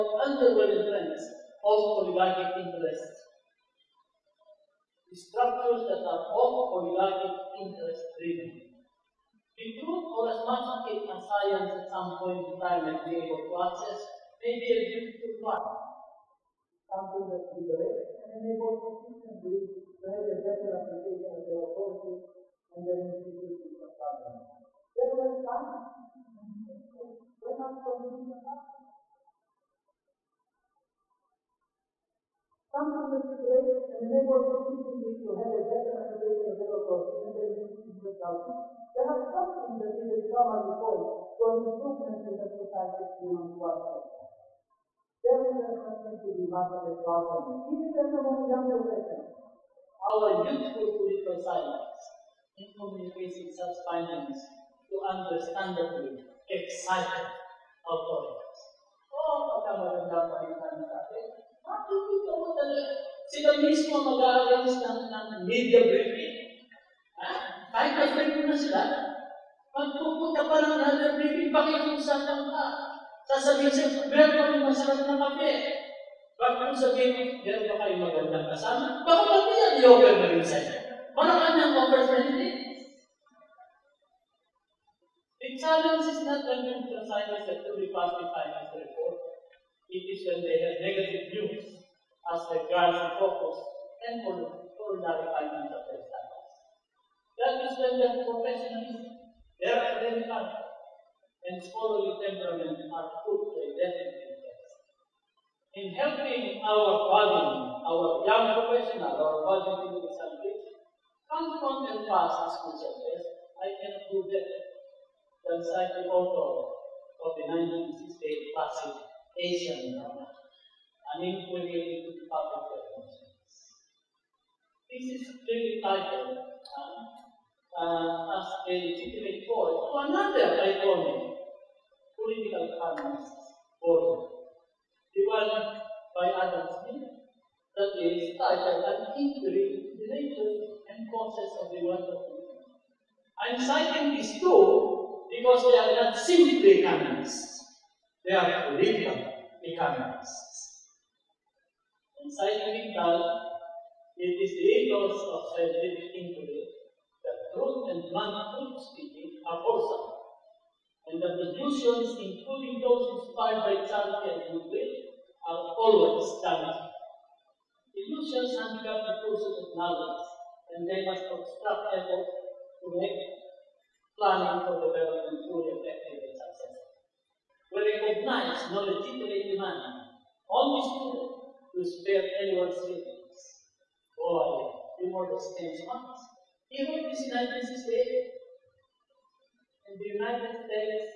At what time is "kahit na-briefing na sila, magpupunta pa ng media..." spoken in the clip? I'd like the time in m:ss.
1:07.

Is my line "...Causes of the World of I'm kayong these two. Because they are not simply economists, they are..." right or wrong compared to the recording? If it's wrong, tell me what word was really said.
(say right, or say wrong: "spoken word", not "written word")
wrong: "citing", not "kayong".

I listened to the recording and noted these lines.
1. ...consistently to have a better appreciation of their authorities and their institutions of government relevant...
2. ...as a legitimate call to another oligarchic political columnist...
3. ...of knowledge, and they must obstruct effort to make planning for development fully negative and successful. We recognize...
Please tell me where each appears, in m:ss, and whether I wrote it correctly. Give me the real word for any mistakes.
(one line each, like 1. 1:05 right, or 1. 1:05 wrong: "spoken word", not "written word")
1. 0:18 right
2. 2:08 wrong: "iconic", not "oligarchic"
3. 2:49 wrong: "effective", not "negative".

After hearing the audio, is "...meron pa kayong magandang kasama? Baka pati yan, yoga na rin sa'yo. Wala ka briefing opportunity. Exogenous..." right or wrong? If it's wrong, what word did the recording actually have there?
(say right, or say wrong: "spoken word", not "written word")
wrong: "niyang", not "briefing".